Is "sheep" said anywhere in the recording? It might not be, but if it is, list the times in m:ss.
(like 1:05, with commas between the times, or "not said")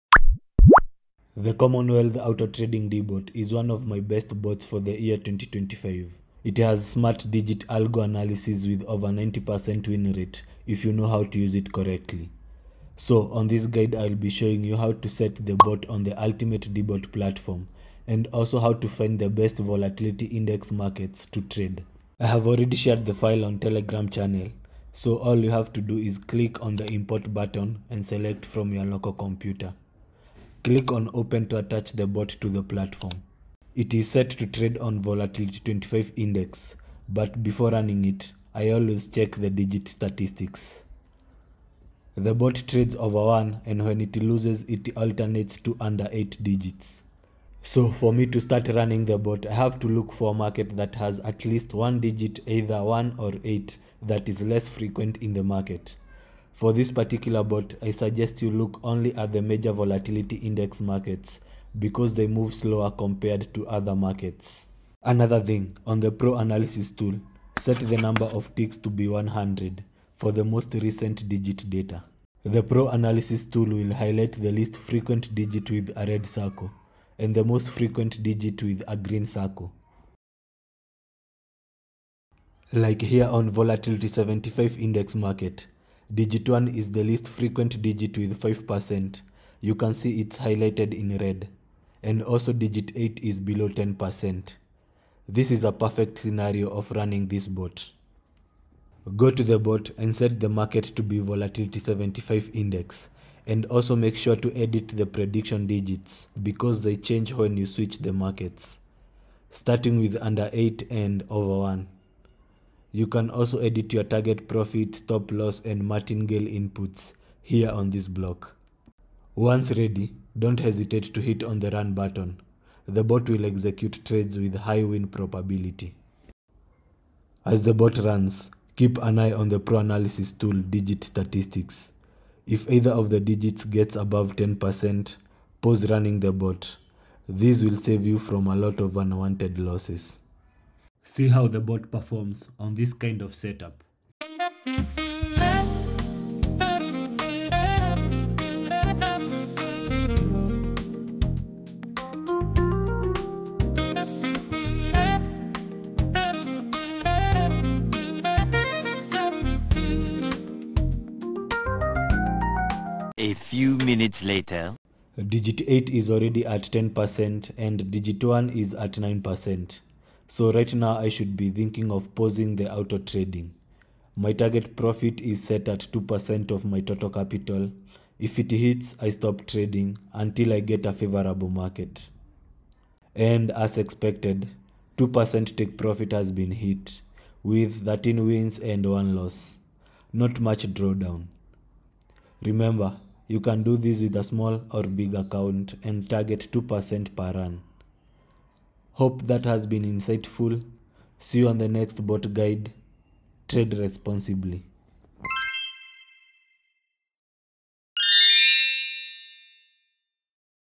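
not said.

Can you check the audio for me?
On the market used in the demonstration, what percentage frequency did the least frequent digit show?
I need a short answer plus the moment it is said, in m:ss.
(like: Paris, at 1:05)
5%, at 1:28.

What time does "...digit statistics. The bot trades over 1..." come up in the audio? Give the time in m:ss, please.
0:39.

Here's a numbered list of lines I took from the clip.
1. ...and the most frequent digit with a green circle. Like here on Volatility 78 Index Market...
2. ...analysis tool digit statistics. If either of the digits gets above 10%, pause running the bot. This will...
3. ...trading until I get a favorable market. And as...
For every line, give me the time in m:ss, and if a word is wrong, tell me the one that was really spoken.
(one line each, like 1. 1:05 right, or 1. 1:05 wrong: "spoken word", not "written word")
1. 1:17 wrong: "75", not "78"
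2. 2:09 right
3. 2:59 right.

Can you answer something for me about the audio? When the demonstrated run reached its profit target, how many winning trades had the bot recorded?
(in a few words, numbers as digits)
13.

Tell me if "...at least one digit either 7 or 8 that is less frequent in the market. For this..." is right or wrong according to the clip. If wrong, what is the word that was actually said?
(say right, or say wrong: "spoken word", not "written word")
wrong: "1", not "7".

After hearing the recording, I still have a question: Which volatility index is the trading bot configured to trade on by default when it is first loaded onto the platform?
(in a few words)
Volatility 25 index.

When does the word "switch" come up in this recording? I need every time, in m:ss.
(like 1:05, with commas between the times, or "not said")
1:47.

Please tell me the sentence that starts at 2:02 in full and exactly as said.
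The bot will execute trades with high win probability.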